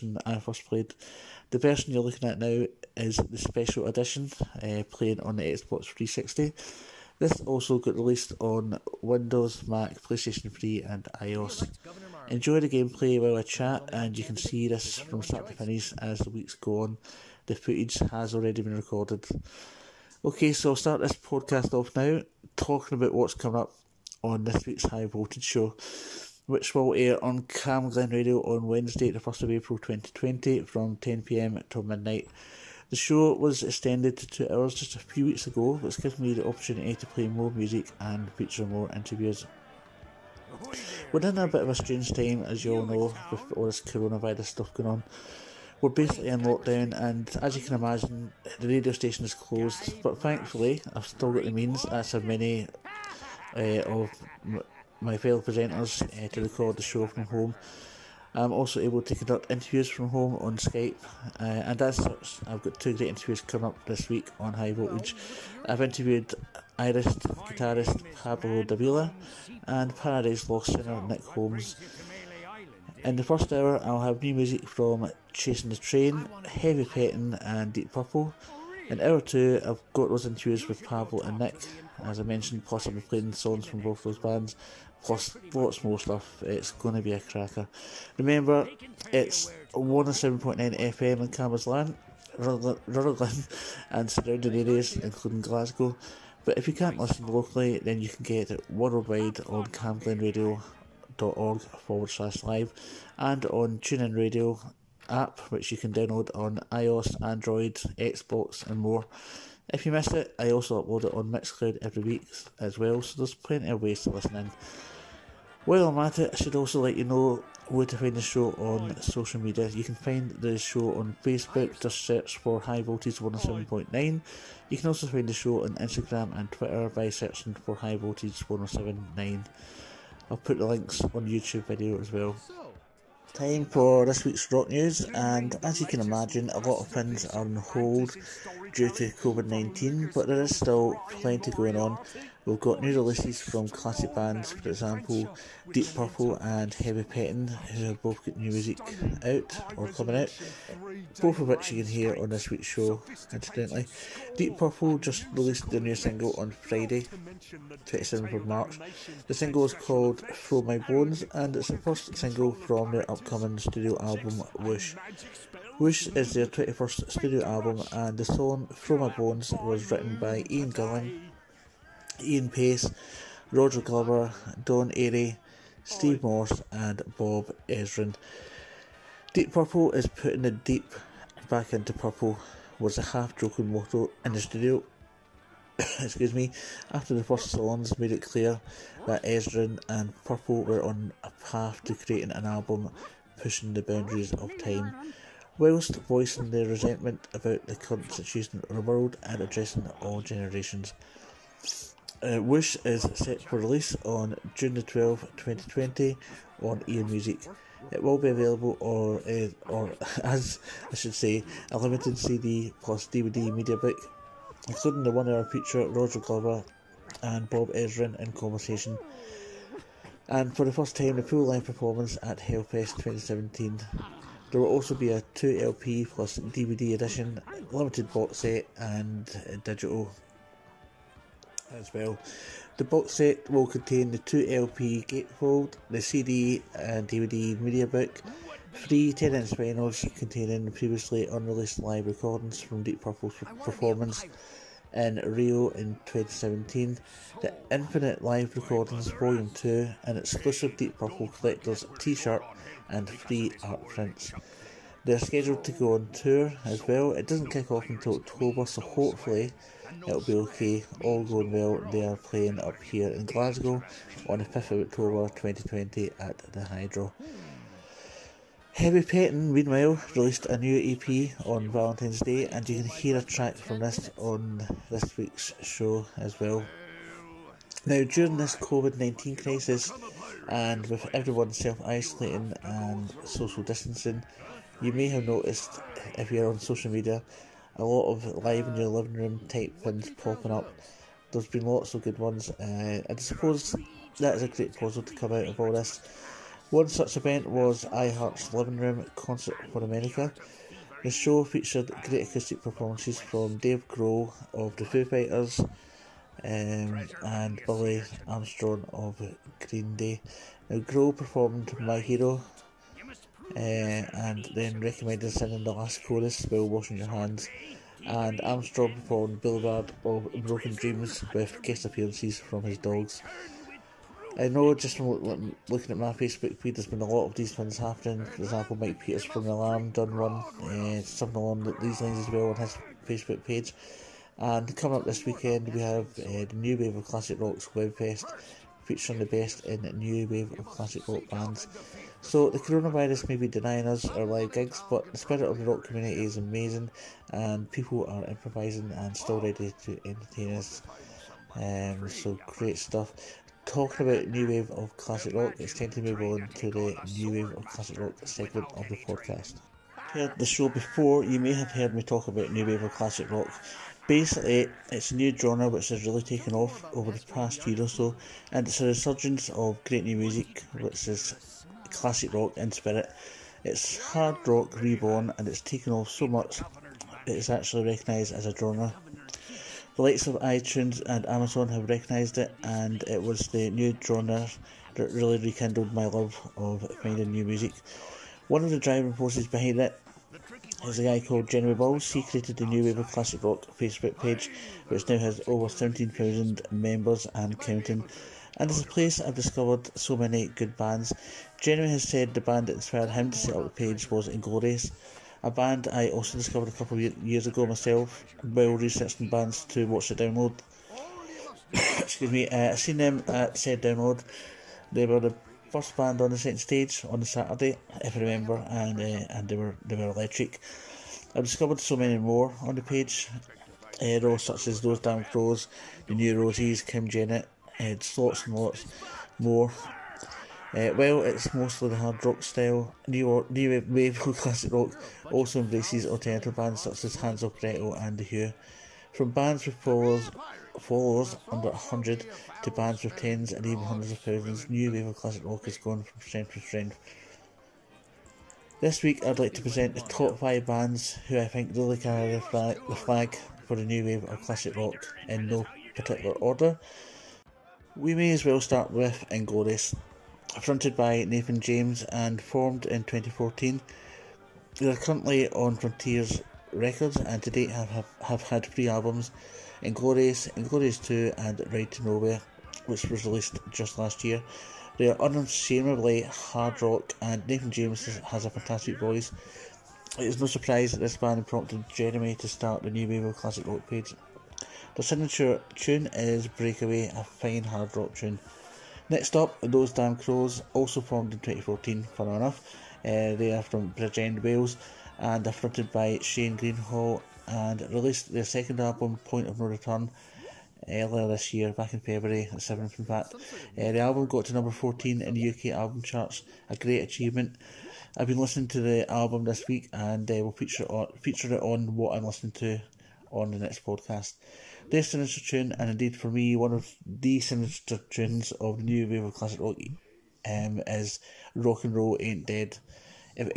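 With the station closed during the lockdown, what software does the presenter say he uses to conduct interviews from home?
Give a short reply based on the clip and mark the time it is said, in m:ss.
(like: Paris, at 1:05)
Skype, at 1:00.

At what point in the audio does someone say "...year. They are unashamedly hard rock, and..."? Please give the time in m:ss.
7:54.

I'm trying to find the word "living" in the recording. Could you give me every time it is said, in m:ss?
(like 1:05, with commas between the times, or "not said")
4:48, 4:58.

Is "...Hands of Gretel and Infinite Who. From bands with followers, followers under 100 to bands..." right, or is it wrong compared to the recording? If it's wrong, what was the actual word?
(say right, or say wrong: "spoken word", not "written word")
wrong: "The", not "Infinite".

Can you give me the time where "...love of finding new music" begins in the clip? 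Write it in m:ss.
6:26.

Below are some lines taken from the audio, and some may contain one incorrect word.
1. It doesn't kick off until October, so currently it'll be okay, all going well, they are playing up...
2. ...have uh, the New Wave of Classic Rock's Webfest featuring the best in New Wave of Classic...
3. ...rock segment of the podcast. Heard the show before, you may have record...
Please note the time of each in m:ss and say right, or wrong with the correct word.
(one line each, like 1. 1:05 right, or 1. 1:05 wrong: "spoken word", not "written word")
1. 4:17 wrong: "hopefully", not "currently"
2. 5:35 right
3. 5:57 wrong: "heard", not "record".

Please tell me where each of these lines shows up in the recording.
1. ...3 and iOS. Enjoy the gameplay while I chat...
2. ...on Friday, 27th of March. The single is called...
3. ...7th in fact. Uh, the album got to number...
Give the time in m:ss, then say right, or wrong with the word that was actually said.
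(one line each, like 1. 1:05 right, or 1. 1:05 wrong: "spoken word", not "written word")
1. 0:10 right
2. 2:36 right
3. 8:22 right.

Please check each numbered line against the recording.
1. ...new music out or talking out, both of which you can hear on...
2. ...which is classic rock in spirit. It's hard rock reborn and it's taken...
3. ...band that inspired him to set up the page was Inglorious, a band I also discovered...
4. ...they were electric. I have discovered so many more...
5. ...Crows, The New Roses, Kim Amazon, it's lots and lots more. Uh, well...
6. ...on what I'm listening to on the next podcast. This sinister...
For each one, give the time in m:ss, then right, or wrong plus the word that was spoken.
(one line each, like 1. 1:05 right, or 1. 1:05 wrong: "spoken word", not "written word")
1. 2:28 wrong: "coming", not "talking"
2. 6:10 right
3. 6:42 right
4. 6:59 right
5. 7:05 wrong: "Jennett", not "Amazon"
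6. 8:31 right.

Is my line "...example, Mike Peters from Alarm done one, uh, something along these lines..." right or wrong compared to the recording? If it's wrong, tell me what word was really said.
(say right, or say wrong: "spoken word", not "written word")
right.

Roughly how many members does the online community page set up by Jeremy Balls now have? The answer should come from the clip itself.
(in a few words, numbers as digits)
17,000.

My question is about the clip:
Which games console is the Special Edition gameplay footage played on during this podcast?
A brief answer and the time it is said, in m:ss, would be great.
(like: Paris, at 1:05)
Xbox 360, at 0:05.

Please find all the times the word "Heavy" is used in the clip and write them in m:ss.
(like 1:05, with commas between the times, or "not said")
1:16, 2:26, 4:28.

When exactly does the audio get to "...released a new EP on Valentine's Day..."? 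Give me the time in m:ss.
4:30.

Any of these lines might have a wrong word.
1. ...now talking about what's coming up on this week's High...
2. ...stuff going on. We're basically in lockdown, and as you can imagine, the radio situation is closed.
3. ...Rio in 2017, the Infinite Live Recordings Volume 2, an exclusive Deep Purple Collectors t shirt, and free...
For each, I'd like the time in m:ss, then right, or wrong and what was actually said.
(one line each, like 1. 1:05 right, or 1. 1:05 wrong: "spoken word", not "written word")
1. 0:21 right
2. 0:44 wrong: "station", not "situation"
3. 4:05 right.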